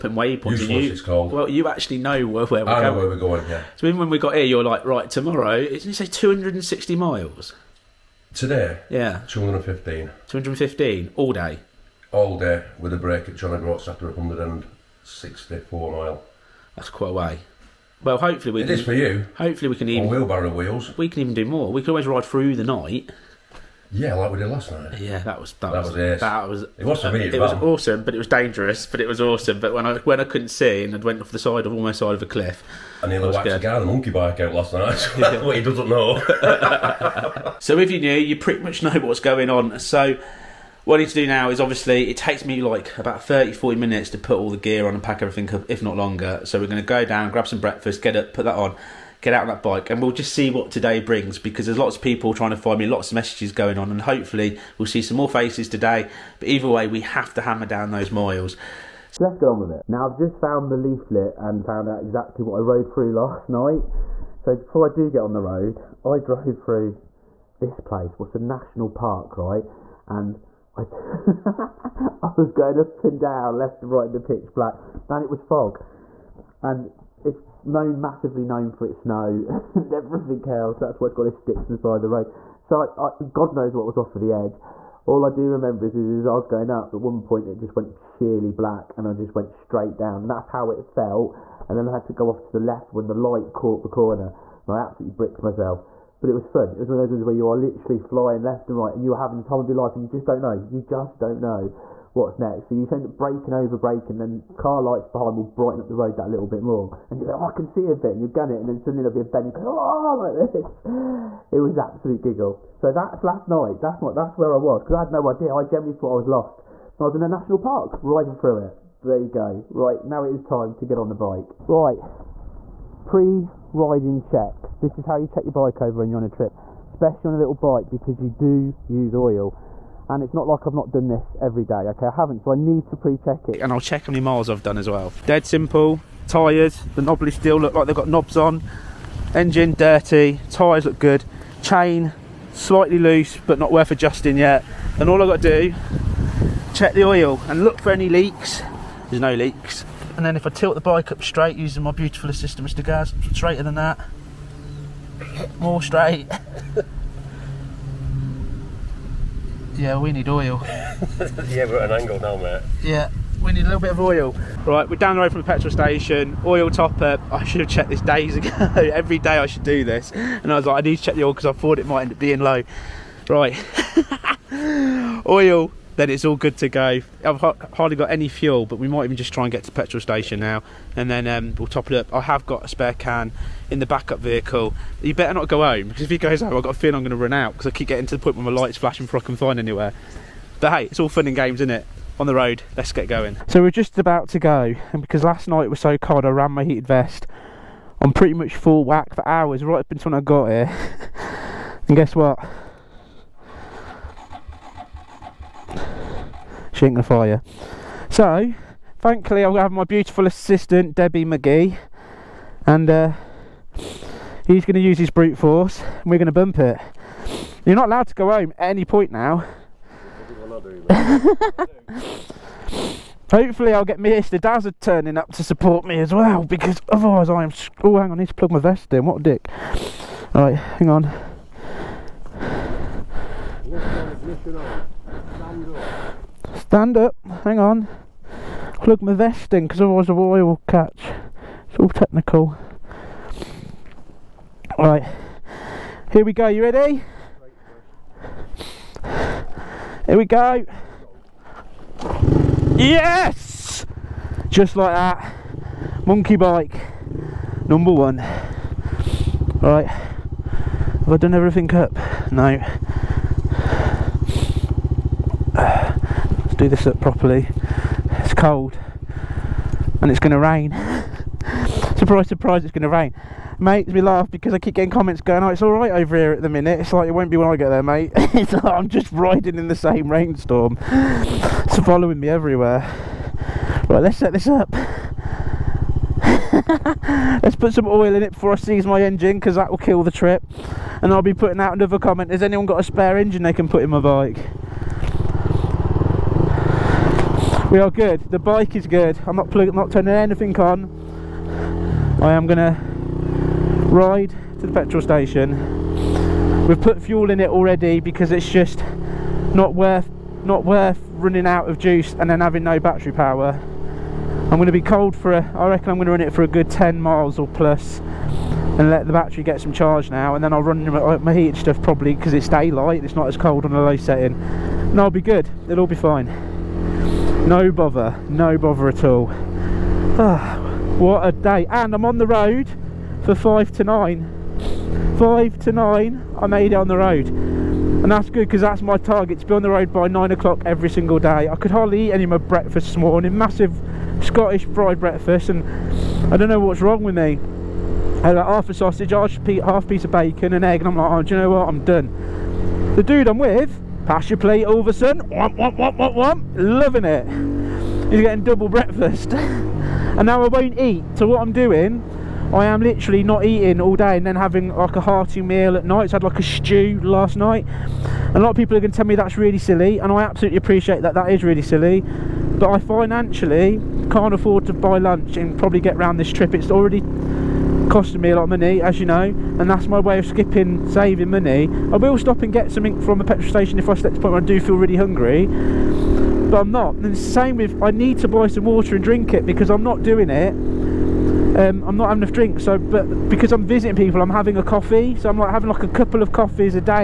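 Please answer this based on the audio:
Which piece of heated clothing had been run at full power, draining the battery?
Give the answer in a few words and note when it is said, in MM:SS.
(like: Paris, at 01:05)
Heated vest, at 03:16.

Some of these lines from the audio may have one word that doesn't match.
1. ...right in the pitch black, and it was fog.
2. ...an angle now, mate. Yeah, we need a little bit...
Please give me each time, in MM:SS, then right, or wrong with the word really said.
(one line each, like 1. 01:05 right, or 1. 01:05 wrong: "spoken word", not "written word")
1. 01:13 right
2. 02:41 right.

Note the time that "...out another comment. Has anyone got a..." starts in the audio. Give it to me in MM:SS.
04:51.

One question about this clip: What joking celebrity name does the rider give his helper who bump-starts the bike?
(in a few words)
Debbie McGee.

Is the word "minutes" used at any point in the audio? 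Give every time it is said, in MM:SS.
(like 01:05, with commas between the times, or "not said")
00:43, 04:36.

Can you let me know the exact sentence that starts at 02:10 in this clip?
And it's not like I've not done this every day, okay?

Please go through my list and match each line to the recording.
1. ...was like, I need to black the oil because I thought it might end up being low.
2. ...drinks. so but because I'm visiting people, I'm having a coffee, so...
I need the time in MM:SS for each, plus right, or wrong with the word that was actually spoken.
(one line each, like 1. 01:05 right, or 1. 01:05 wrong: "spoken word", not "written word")
1. 02:50 wrong: "check", not "black"
2. 06:32 right.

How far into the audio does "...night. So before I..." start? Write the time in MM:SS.
01:03.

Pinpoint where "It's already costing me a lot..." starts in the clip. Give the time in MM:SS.
06:16.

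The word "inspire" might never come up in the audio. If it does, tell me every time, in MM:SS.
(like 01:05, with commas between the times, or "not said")
not said.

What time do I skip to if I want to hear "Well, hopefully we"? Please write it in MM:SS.
00:18.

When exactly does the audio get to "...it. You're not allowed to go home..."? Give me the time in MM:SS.
03:36.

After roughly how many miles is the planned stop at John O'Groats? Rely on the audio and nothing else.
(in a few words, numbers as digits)
164.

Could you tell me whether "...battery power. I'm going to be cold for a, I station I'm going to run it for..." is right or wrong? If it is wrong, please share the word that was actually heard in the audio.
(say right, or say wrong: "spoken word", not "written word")
wrong: "reckon", not "station".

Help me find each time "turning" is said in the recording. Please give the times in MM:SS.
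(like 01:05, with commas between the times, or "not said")
03:44, 04:59.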